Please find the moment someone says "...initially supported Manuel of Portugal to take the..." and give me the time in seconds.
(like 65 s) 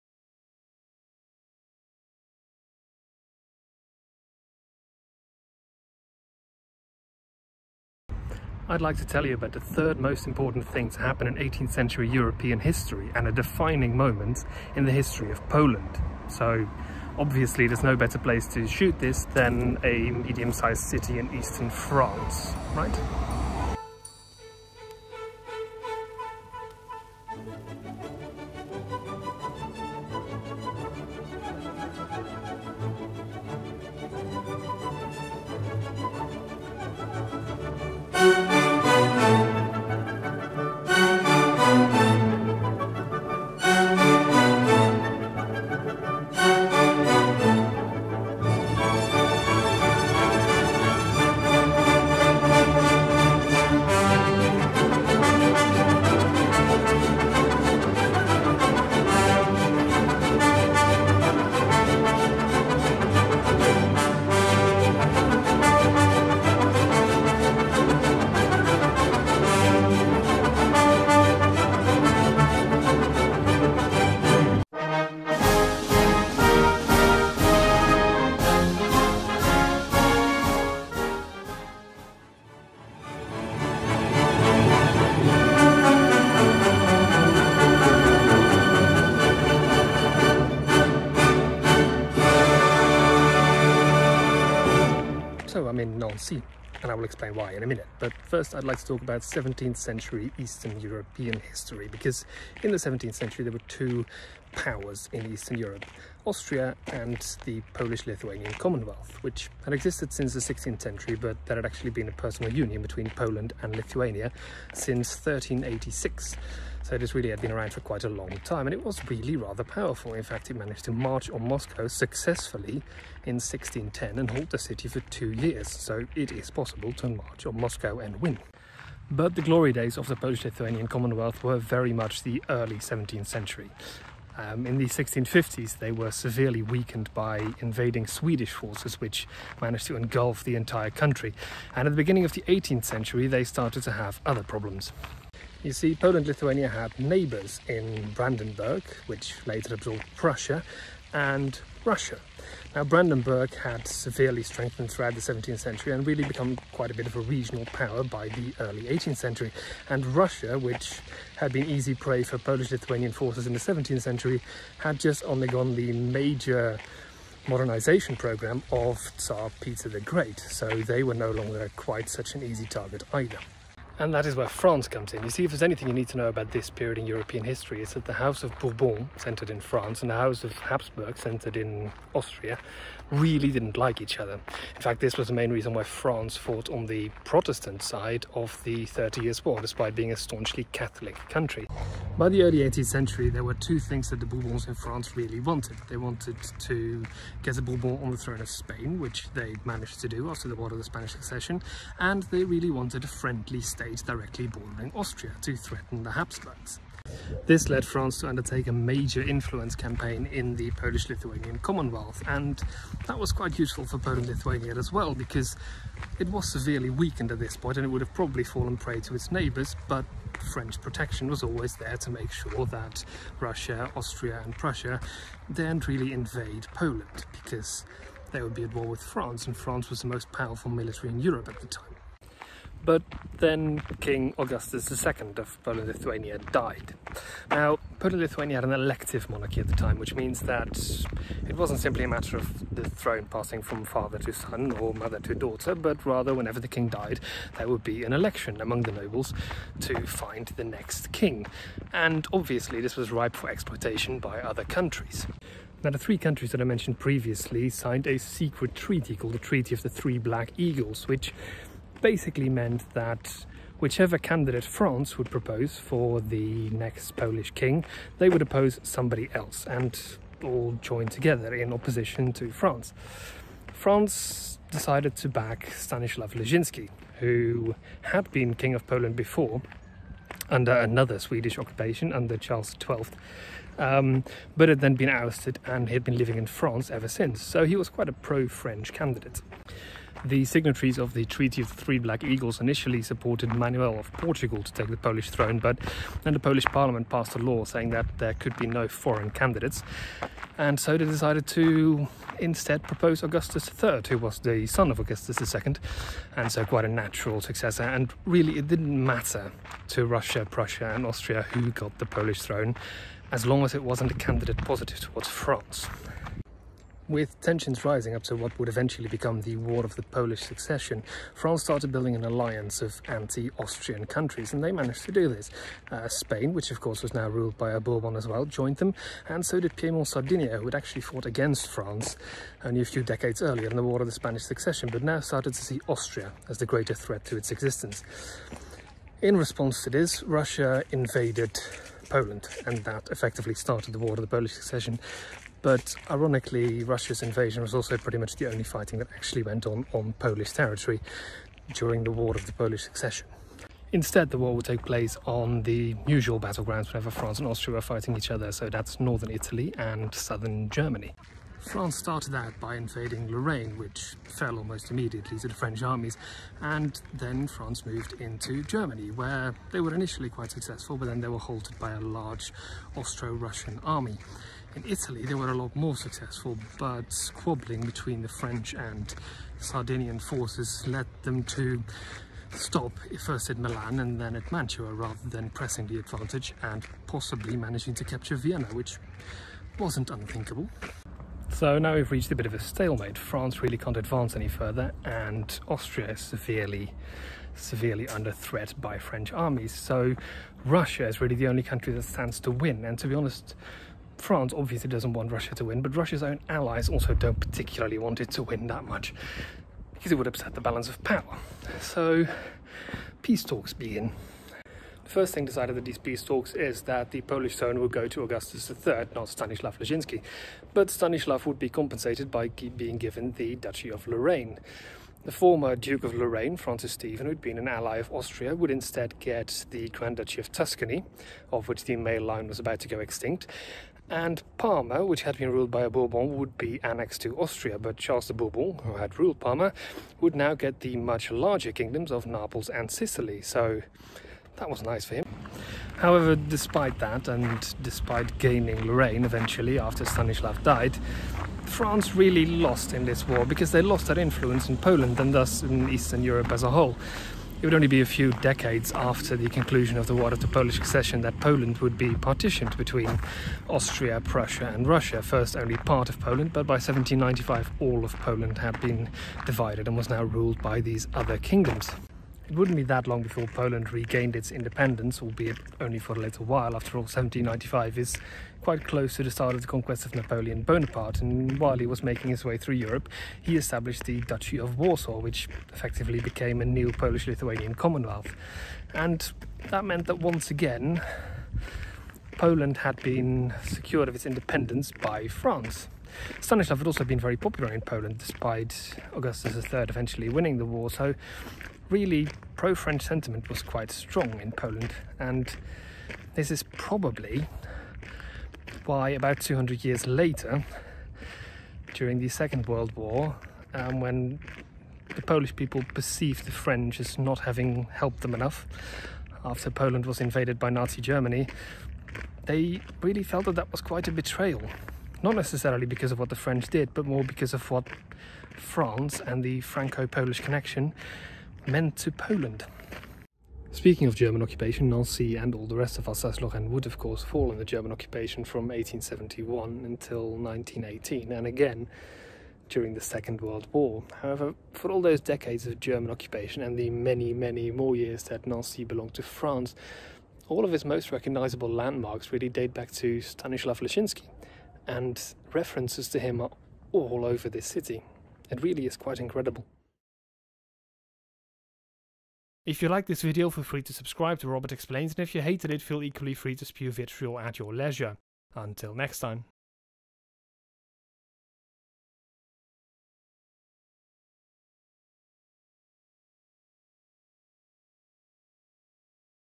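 292 s.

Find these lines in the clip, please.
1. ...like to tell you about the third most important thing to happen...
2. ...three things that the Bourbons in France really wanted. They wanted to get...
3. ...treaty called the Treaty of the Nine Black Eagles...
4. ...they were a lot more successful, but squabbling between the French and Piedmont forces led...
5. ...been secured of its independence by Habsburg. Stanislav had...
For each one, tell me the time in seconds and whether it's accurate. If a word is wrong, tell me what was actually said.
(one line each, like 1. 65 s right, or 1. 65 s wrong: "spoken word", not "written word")
1. 8 s right
2. 193 s wrong: "two", not "three"
3. 258 s wrong: "Three", not "Nine"
4. 375 s wrong: "Sardinian", not "Piedmont"
5. 493 s wrong: "France", not "Habsburg".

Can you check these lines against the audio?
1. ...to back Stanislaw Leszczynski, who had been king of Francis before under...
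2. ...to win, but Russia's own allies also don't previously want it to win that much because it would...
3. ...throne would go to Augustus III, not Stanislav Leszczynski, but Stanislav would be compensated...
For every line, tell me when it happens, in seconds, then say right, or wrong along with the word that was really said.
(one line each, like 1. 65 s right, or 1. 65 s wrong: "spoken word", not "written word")
1. 275 s wrong: "Poland", not "Francis"
2. 405 s wrong: "particularly", not "previously"
3. 417 s right.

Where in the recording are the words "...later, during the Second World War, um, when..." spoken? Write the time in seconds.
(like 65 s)
510 s.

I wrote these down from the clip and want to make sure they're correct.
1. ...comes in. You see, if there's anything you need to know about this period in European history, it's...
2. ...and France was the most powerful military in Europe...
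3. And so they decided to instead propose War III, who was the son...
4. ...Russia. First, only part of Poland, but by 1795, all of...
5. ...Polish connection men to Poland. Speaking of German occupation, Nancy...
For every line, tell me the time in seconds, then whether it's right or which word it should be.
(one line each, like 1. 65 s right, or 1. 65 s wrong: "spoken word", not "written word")
1. 174 s right
2. 229 s right
3. 300 s wrong: "Augustus", not "War"
4. 464 s right
5. 530 s right.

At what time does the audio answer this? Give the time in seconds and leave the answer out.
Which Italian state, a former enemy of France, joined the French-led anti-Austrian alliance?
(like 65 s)
329 s.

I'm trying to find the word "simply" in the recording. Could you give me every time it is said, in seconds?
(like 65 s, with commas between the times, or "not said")
241 s.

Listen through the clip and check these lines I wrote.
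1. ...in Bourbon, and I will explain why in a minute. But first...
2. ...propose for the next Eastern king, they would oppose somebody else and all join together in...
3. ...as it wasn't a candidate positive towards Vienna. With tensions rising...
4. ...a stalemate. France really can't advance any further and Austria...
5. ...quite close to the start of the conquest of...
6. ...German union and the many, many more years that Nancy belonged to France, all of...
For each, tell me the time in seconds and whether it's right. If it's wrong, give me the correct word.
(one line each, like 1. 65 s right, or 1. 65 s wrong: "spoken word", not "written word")
1. 95 s wrong: "Nancy", not "Bourbon"
2. 265 s wrong: "Polish", not "Eastern"
3. 313 s wrong: "France", not "Vienna"
4. 392 s right
5. 478 s right
6. 545 s wrong: "occupation", not "union".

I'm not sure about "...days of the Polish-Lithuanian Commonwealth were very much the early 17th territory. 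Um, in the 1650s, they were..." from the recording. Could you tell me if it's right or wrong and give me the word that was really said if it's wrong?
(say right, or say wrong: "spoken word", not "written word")
wrong: "century", not "territory".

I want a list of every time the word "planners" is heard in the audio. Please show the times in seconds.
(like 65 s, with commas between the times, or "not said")
not said.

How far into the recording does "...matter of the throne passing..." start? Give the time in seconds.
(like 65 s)
242 s.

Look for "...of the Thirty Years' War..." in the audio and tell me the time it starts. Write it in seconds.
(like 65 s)
188 s.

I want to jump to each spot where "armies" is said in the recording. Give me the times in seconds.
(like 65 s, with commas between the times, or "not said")
365 s, 399 s.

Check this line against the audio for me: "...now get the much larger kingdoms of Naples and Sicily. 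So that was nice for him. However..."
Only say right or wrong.
right.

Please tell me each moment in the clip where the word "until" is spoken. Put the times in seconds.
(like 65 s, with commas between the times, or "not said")
539 s, 568 s.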